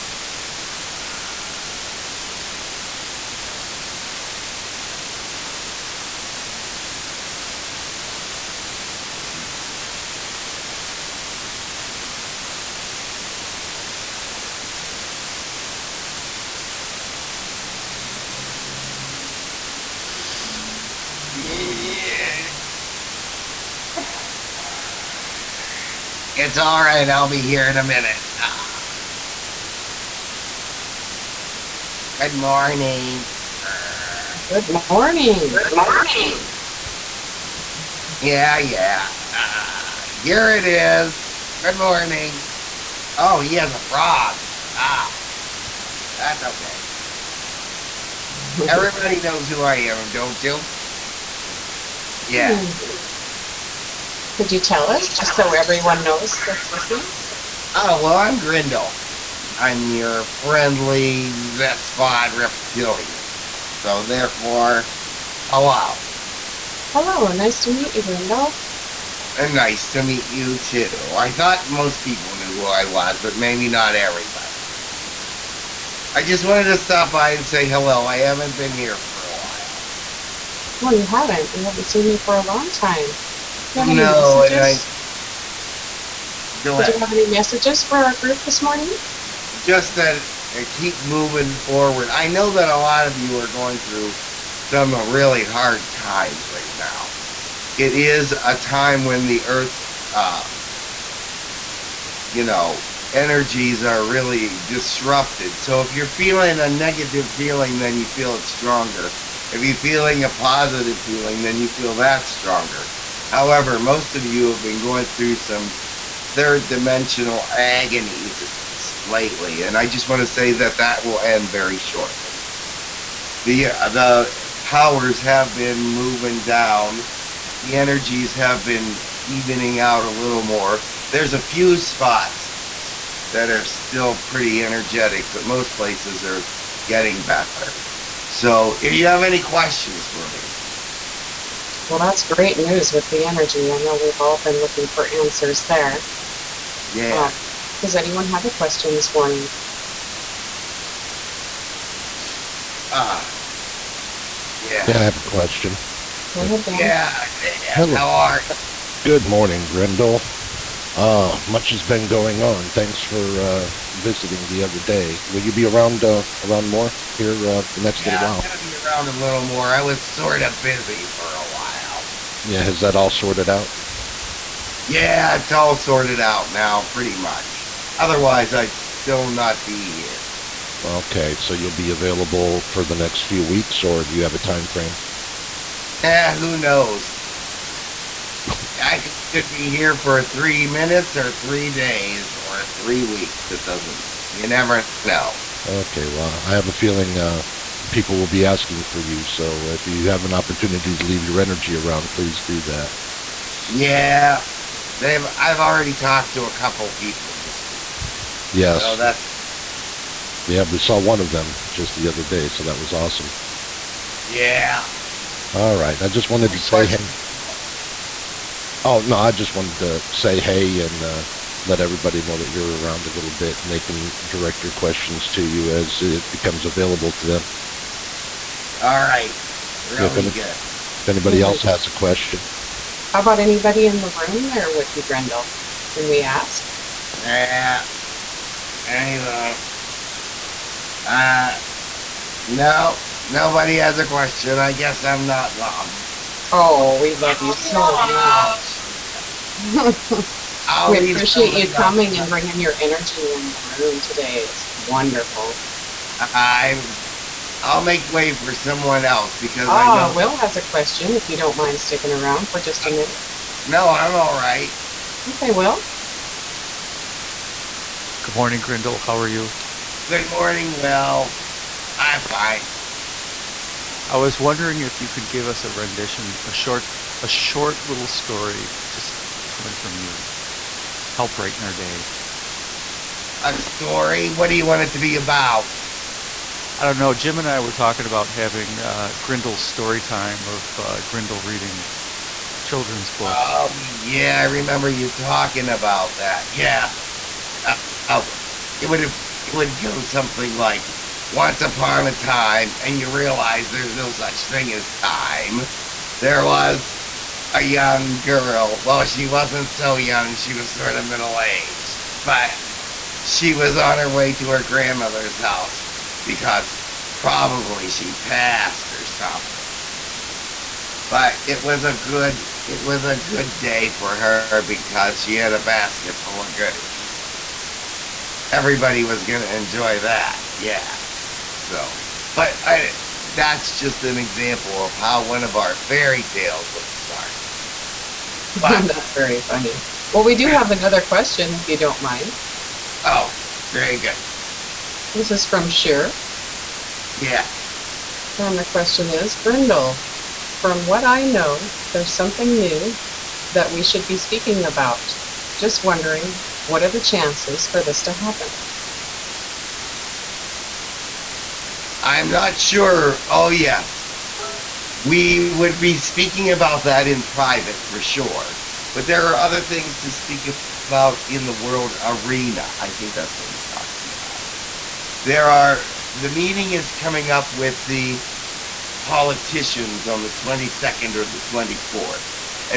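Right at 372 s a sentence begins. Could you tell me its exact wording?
I think that's what he's talking about.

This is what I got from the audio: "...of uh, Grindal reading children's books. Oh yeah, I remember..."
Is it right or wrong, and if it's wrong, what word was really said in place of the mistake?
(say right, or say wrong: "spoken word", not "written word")
right.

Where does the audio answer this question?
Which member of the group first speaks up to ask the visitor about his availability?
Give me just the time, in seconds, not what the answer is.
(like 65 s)
156 s.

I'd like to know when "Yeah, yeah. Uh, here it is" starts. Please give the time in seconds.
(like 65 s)
38 s.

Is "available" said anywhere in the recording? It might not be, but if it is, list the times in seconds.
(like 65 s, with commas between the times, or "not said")
181 s, 226 s.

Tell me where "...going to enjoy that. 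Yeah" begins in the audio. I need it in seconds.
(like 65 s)
329 s.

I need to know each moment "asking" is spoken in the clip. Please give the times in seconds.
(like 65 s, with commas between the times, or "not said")
198 s.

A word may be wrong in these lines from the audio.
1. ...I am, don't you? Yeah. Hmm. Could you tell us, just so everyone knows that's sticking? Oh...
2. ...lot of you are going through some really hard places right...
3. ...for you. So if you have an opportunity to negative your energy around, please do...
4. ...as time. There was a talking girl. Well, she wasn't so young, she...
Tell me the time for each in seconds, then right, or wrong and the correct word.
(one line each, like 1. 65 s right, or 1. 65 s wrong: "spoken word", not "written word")
1. 49 s wrong: "listening", not "sticking"
2. 92 s wrong: "times", not "places"
3. 198 s wrong: "leave", not "negative"
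4. 304 s wrong: "young", not "talking".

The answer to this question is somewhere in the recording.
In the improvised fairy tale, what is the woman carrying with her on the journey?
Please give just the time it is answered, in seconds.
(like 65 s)
325 s.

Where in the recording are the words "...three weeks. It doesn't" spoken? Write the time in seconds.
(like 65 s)
192 s.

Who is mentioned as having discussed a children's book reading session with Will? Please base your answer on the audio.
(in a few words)
Jim.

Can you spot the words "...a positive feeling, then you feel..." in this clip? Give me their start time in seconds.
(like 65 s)
110 s.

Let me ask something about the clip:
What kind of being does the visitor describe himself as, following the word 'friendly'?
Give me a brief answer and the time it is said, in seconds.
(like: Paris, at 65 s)
Zespod reptilian, at 61 s.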